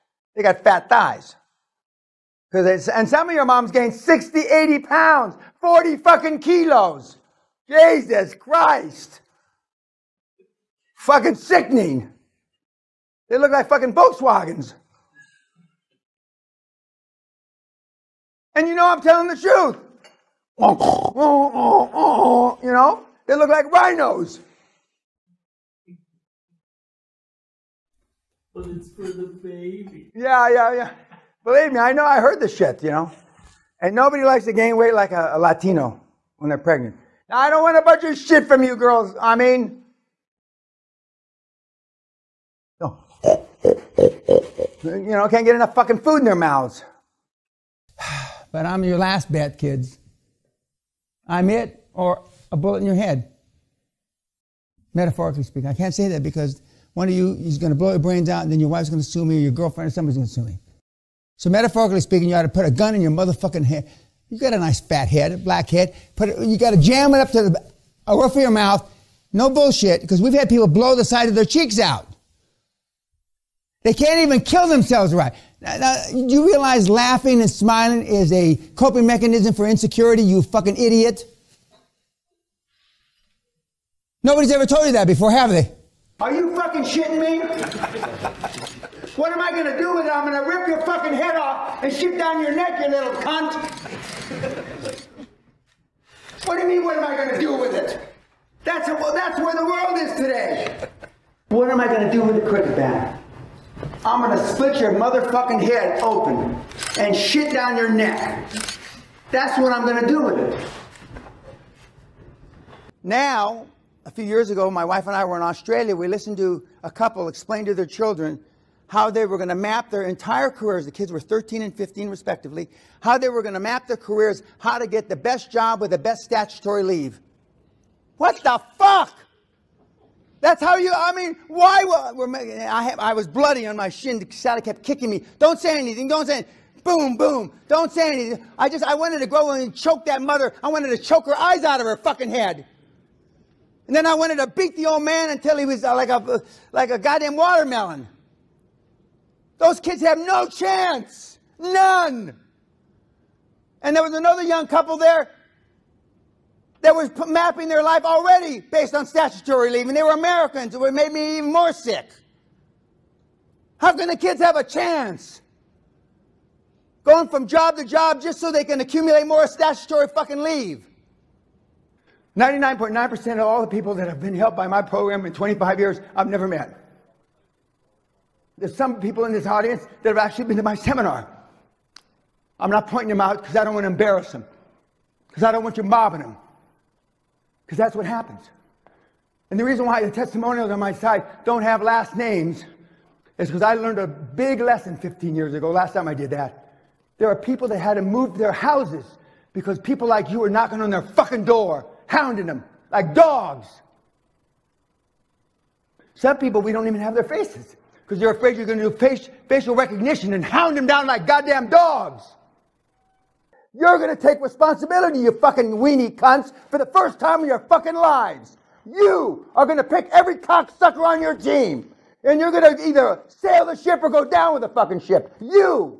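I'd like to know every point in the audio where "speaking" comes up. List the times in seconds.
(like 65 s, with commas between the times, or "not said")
55 s, 62 s.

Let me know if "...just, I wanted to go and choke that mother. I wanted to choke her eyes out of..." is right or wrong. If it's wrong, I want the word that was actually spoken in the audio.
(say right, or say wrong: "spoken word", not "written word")
right.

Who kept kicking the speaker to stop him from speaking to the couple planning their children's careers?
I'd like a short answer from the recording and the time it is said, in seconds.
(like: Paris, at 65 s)
Sally, at 134 s.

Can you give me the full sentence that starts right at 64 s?
You got a nice fat head, a black head.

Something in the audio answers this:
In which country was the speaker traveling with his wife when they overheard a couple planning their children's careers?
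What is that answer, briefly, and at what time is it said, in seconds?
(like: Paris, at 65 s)
Australia, at 115 s.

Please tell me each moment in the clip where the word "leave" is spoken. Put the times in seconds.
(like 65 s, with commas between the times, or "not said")
126 s, 159 s, 170 s.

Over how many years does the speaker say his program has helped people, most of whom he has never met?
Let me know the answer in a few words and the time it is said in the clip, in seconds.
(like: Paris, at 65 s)
25 years, at 175 s.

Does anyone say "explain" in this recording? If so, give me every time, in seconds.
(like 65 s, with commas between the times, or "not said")
117 s.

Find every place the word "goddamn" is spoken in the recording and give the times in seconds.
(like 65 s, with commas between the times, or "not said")
146 s, 211 s.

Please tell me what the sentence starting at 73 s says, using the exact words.
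They can't even kill themselves right.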